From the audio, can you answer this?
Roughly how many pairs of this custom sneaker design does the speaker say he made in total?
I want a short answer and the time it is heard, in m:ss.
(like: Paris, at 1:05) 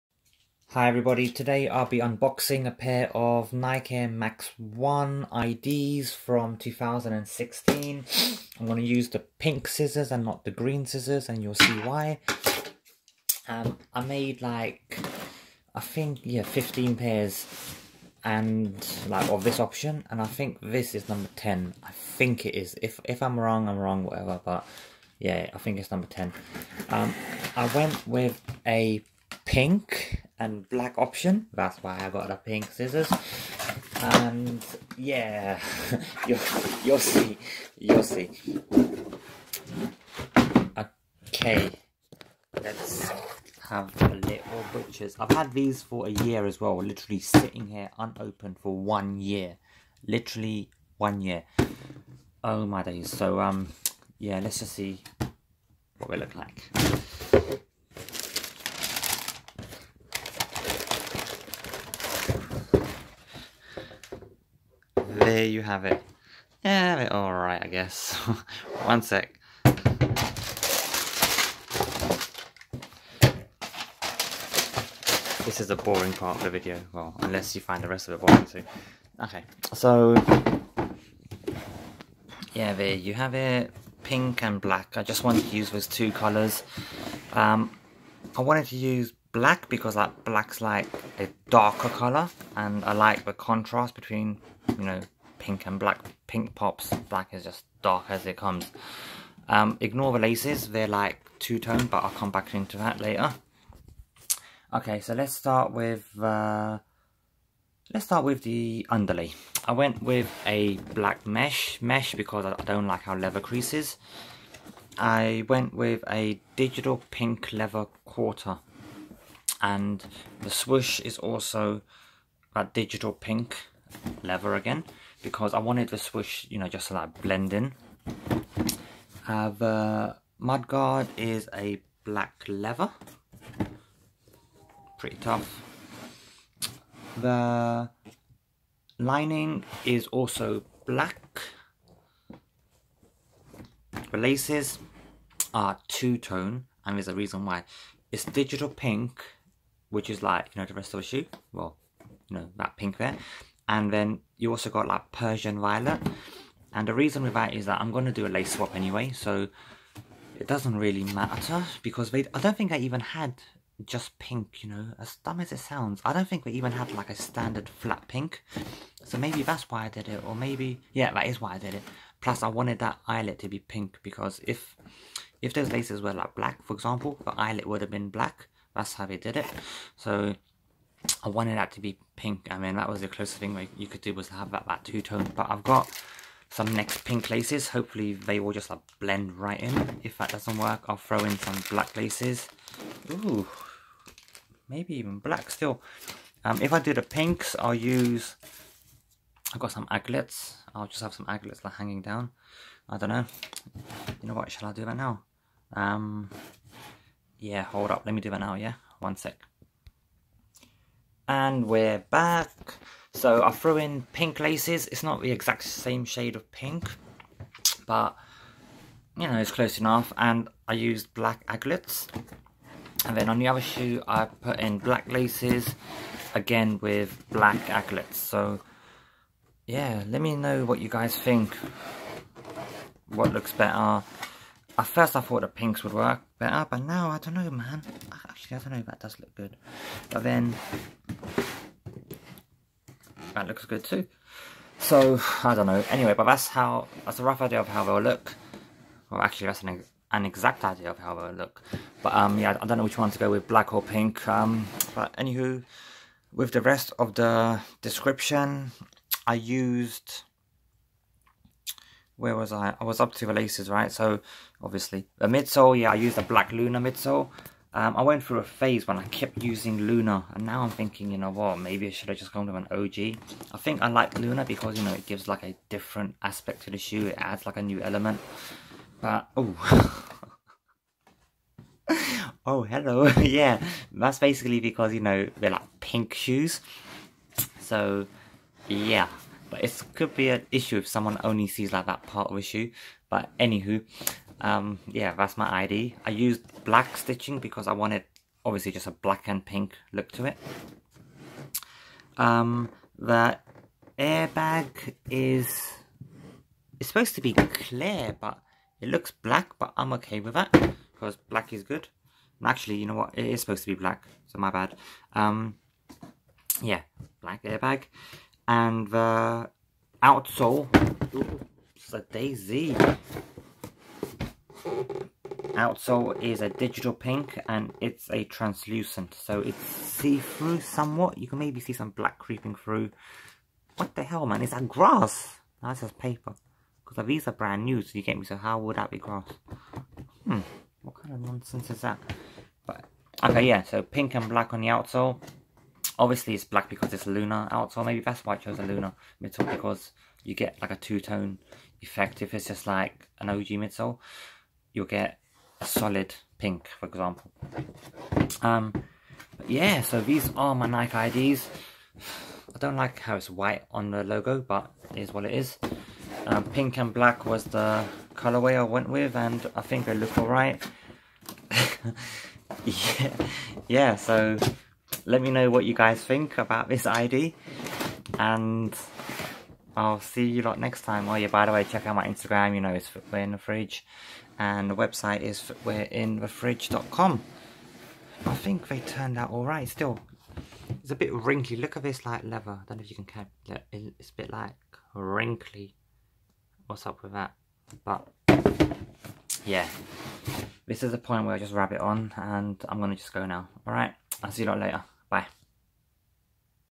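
15, at 0:16.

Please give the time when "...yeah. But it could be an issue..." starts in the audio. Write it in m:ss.
4:48.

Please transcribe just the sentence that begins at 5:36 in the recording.
Because these are brand new, so you get me, so how would that be grass?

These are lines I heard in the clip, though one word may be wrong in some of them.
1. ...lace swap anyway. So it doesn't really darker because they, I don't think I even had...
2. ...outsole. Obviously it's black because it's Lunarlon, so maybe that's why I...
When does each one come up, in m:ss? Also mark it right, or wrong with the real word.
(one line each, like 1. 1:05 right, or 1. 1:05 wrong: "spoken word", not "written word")
1. 2:38 wrong: "matter", not "darker"
2. 5:44 right.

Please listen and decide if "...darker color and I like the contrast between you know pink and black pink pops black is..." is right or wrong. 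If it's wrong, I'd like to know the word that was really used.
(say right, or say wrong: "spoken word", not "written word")
right.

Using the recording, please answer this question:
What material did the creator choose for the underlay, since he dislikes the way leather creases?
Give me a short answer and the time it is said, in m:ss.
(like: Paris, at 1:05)
black mesh, at 1:50.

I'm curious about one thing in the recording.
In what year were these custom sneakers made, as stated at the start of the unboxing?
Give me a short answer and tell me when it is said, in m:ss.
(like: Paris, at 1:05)
2016, at 0:06.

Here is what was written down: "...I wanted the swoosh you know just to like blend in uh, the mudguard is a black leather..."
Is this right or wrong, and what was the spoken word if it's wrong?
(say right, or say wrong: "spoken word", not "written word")
right.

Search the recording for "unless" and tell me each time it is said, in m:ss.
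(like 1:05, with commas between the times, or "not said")
1:17.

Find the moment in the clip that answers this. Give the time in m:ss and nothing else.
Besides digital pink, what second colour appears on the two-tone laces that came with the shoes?
2:35.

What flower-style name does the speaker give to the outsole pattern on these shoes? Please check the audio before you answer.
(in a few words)
daisy.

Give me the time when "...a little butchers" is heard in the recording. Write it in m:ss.
0:44.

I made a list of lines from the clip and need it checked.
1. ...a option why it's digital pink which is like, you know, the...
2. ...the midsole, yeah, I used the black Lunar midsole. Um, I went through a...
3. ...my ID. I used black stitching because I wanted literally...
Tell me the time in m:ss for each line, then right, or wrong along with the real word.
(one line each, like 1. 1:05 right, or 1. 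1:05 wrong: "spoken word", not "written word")
1. 2:27 wrong: "reason", not "option"
2. 4:25 right
3. 4:55 wrong: "obviously", not "literally".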